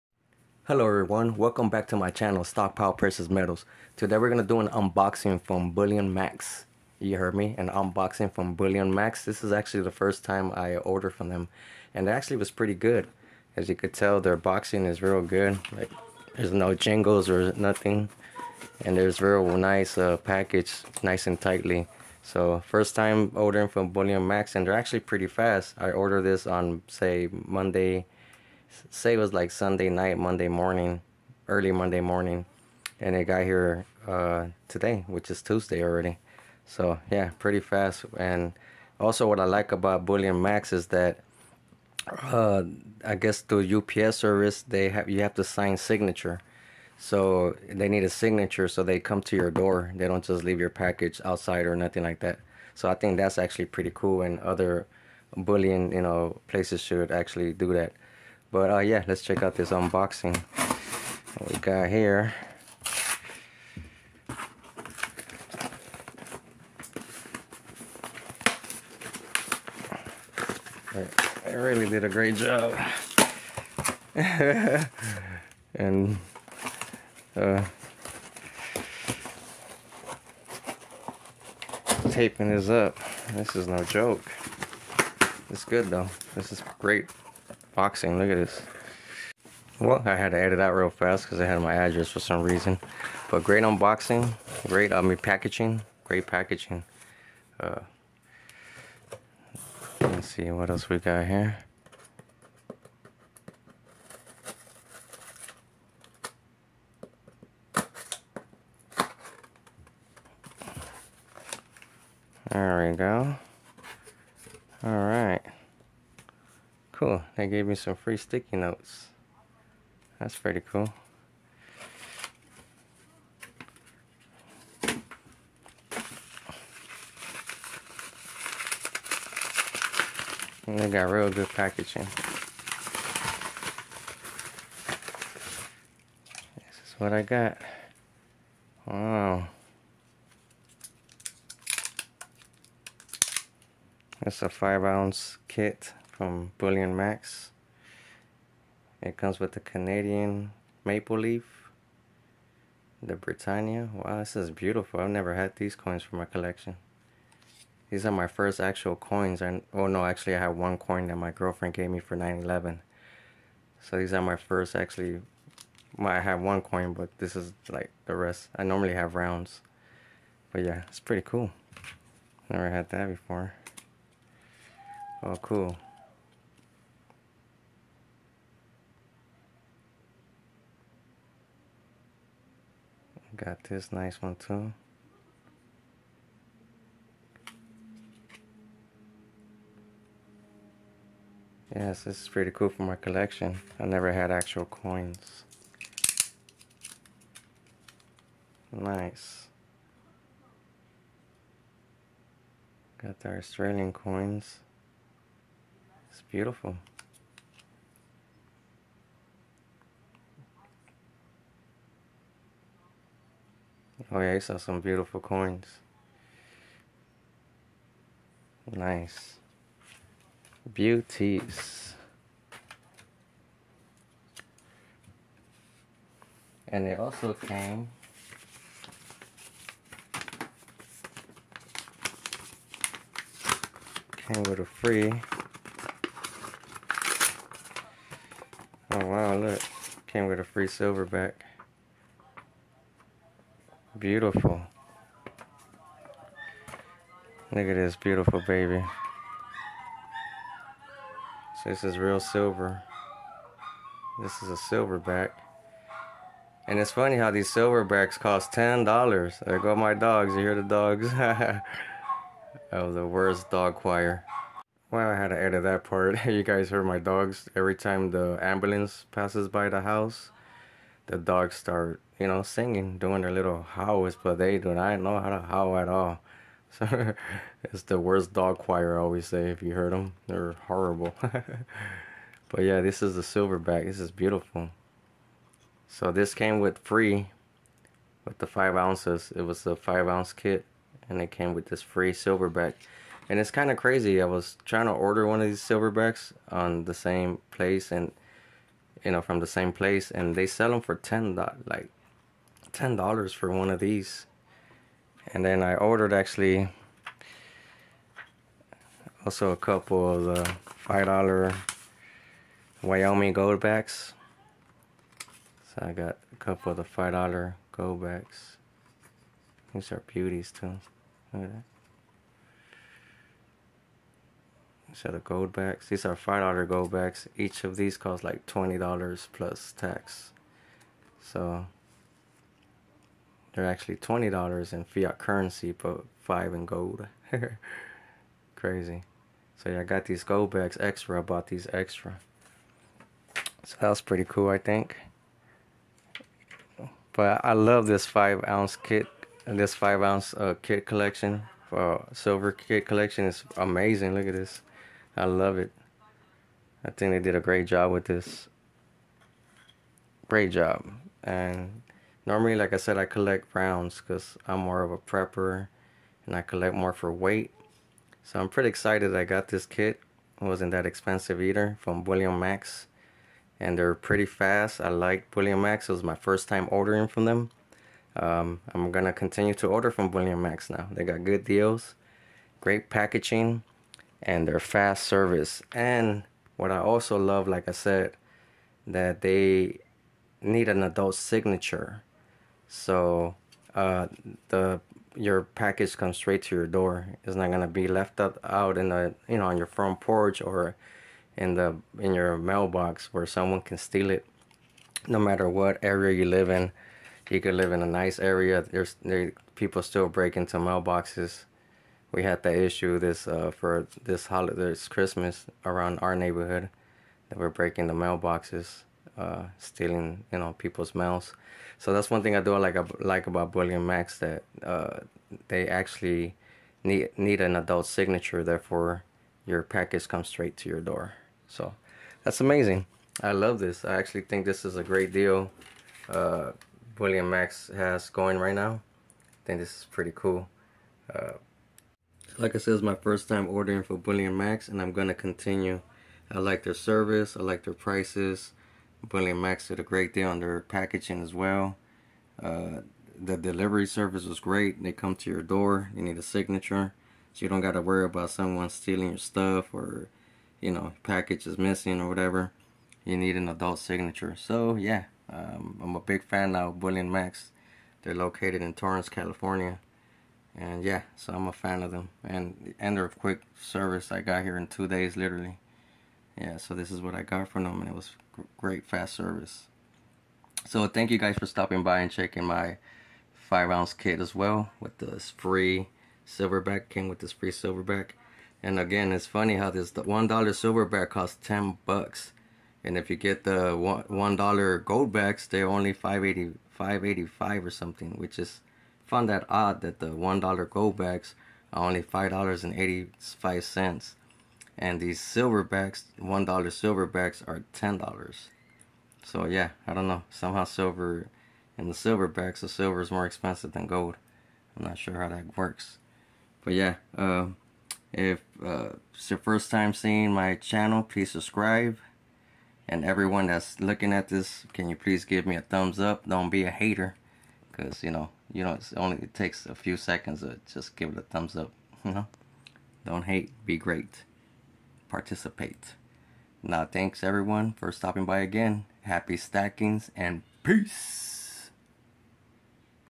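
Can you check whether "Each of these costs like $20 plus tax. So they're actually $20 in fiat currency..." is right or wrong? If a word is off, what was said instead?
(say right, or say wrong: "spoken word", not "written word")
right.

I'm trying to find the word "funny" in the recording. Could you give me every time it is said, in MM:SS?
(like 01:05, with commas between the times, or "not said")
04:16, 08:09.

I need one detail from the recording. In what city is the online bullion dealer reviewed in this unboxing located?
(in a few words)
Torrance, California.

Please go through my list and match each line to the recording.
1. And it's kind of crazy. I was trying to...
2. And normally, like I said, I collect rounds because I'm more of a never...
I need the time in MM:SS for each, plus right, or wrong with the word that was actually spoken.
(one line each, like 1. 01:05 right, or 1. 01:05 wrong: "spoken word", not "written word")
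1. 04:53 right
2. 06:01 wrong: "prepper", not "never".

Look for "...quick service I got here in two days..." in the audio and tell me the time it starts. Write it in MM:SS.
07:53.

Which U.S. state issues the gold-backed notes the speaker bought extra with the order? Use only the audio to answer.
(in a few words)
Wyoming.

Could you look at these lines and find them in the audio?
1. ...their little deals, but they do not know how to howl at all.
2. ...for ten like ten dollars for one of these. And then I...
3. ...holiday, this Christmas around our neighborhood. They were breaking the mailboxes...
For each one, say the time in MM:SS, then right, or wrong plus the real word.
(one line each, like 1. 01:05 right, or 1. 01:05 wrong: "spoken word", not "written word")
1. 04:33 wrong: "howls", not "deals"
2. 05:00 right
3. 06:54 right.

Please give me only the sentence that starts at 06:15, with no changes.
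It was my first time ordering from them.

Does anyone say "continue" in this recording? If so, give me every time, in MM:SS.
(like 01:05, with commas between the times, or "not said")
06:19, 07:25.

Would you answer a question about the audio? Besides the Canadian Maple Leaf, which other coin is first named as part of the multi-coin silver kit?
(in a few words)
Britannia.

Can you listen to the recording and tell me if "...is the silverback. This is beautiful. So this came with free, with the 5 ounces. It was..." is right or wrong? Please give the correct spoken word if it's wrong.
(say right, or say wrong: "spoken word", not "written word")
right.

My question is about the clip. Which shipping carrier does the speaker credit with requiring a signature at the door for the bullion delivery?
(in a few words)
UPS.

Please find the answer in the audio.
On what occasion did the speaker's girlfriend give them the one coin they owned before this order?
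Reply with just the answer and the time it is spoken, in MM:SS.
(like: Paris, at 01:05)
9-11, at 02:42.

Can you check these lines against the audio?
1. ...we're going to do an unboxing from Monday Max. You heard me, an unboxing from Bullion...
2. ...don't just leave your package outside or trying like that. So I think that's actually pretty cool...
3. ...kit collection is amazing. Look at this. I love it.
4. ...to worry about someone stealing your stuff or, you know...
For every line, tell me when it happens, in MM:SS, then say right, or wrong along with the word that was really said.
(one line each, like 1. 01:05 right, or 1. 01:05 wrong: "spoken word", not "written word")
1. 00:04 wrong: "Bullion", not "Monday"
2. 00:50 wrong: "nothing", not "trying"
3. 05:52 right
4. 07:37 right.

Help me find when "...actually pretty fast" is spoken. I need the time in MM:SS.
00:24.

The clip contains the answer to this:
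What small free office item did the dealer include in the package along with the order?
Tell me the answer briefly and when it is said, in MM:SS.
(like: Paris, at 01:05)
Sticky notes, at 01:58.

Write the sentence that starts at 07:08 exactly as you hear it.
Therefore, your package comes straight to your door.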